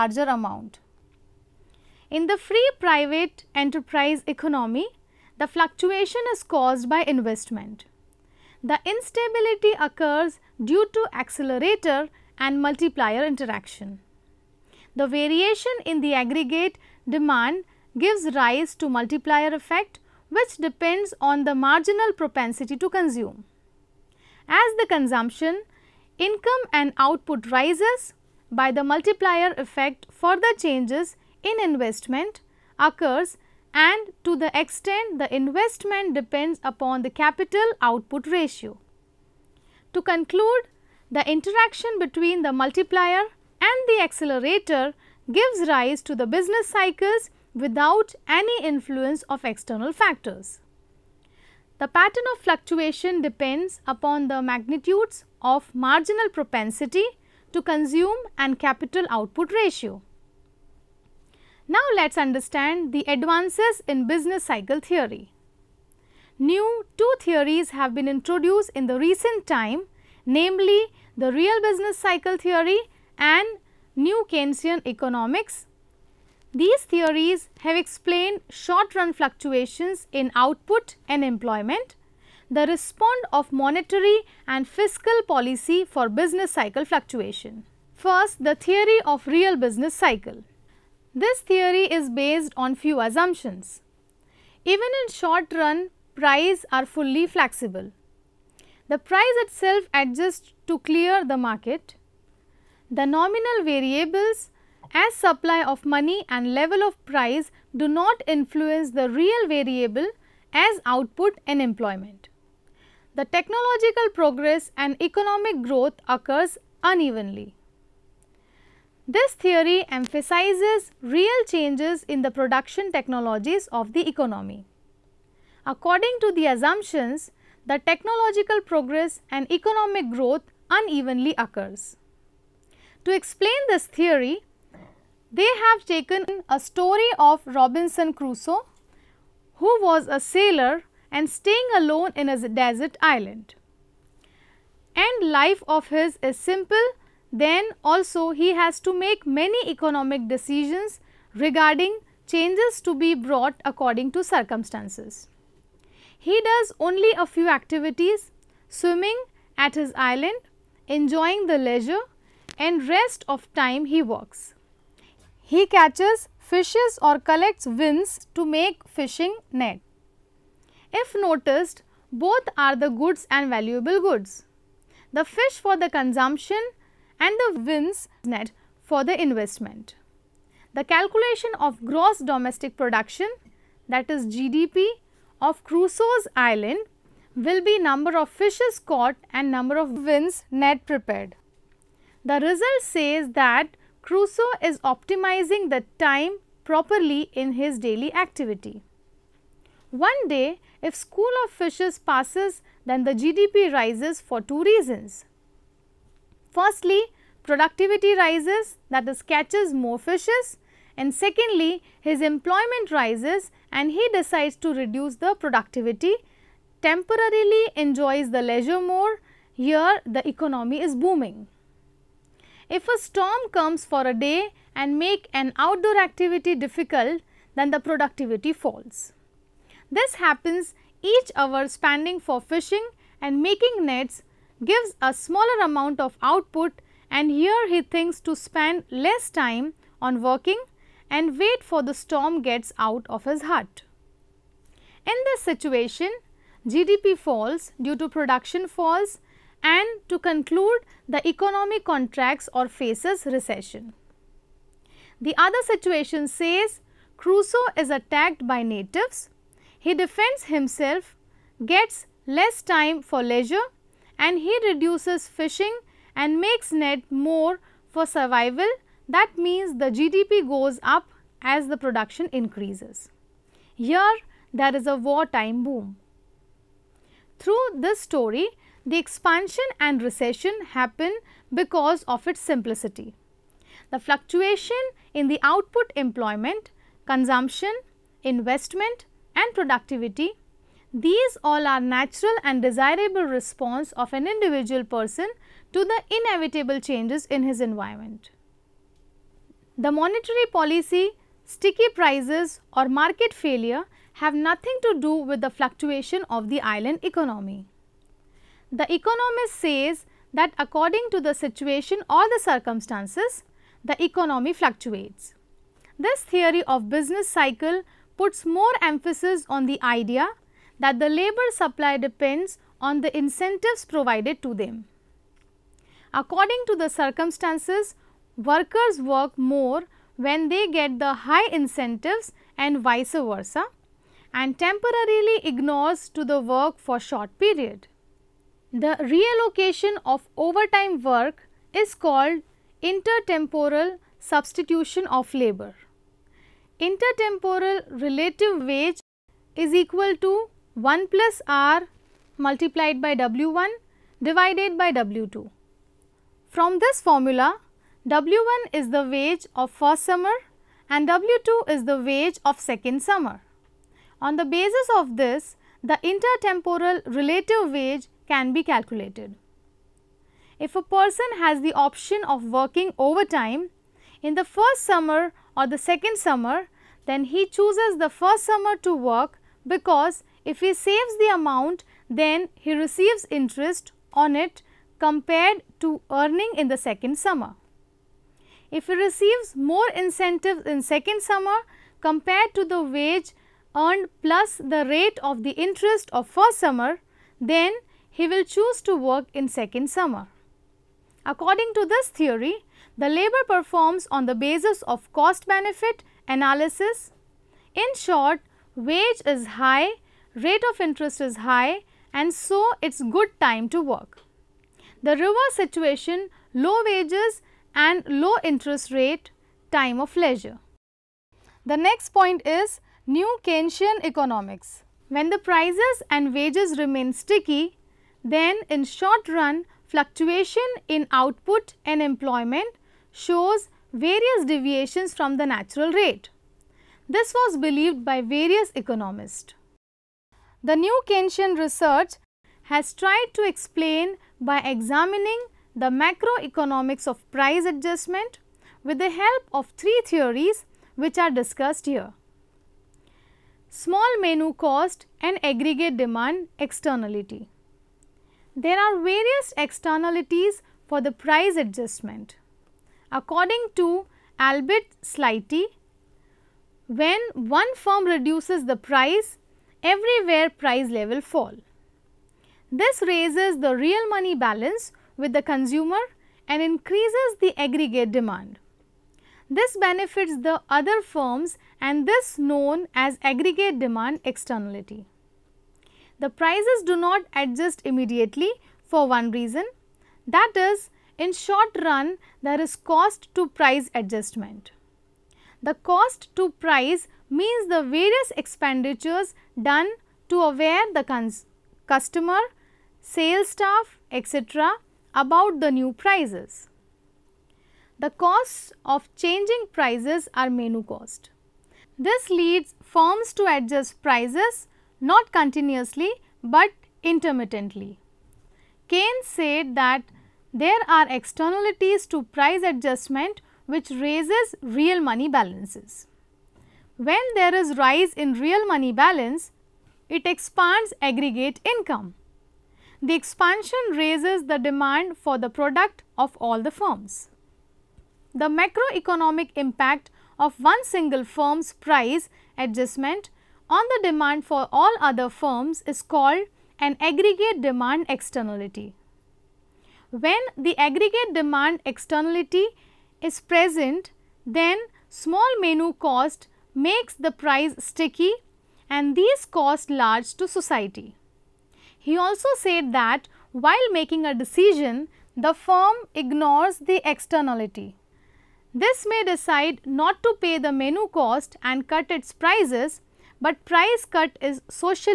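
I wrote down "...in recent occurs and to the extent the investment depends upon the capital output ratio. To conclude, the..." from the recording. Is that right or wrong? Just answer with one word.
wrong.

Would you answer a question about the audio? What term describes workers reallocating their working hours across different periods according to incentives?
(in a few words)
Intertemporal substitution of labor.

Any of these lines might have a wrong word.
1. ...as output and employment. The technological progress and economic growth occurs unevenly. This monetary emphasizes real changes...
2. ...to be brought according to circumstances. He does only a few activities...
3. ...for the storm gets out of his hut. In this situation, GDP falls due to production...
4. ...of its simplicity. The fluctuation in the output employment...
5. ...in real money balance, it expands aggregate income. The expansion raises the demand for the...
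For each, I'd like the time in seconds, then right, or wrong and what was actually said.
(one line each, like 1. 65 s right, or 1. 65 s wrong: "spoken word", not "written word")
1. 110 s wrong: "theory", not "monetary"
2. 152 s right
3. 241 s right
4. 282 s right
5. 528 s right.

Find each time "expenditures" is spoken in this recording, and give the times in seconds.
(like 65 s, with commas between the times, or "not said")
498 s.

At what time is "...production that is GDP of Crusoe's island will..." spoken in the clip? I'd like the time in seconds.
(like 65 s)
182 s.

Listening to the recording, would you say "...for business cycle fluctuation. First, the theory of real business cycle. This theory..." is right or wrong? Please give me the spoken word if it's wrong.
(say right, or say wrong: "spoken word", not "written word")
right.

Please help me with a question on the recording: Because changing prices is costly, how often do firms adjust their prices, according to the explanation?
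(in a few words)
Intermittently.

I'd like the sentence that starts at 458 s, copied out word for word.
There are various externalities for the price adjustment.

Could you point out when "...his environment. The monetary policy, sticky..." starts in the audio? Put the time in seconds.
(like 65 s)
297 s.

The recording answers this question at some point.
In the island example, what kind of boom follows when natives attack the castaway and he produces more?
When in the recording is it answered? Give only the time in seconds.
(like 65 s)
274 s.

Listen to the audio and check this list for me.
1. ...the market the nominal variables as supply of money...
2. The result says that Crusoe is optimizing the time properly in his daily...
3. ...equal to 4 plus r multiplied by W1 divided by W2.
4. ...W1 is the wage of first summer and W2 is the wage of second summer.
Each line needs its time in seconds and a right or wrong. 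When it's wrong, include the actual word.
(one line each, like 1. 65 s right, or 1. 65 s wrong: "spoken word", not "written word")
1. 101 s right
2. 192 s right
3. 349 s wrong: "1", not "4"
4. 358 s right.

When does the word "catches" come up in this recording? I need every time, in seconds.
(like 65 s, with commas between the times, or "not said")
165 s, 209 s.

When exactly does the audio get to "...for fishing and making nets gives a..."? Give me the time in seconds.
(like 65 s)
232 s.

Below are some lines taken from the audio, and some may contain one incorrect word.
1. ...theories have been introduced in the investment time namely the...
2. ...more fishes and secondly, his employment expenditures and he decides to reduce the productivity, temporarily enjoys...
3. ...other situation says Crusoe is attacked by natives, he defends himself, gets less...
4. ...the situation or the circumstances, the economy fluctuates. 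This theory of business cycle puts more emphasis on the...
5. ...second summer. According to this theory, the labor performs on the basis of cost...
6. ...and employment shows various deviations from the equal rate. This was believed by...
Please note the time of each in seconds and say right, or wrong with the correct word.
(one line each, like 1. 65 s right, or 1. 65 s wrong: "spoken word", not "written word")
1. 67 s wrong: "recent", not "investment"
2. 209 s wrong: "rises", not "expenditures"
3. 255 s right
4. 311 s right
5. 399 s right
6. 431 s wrong: "natural", not "equal".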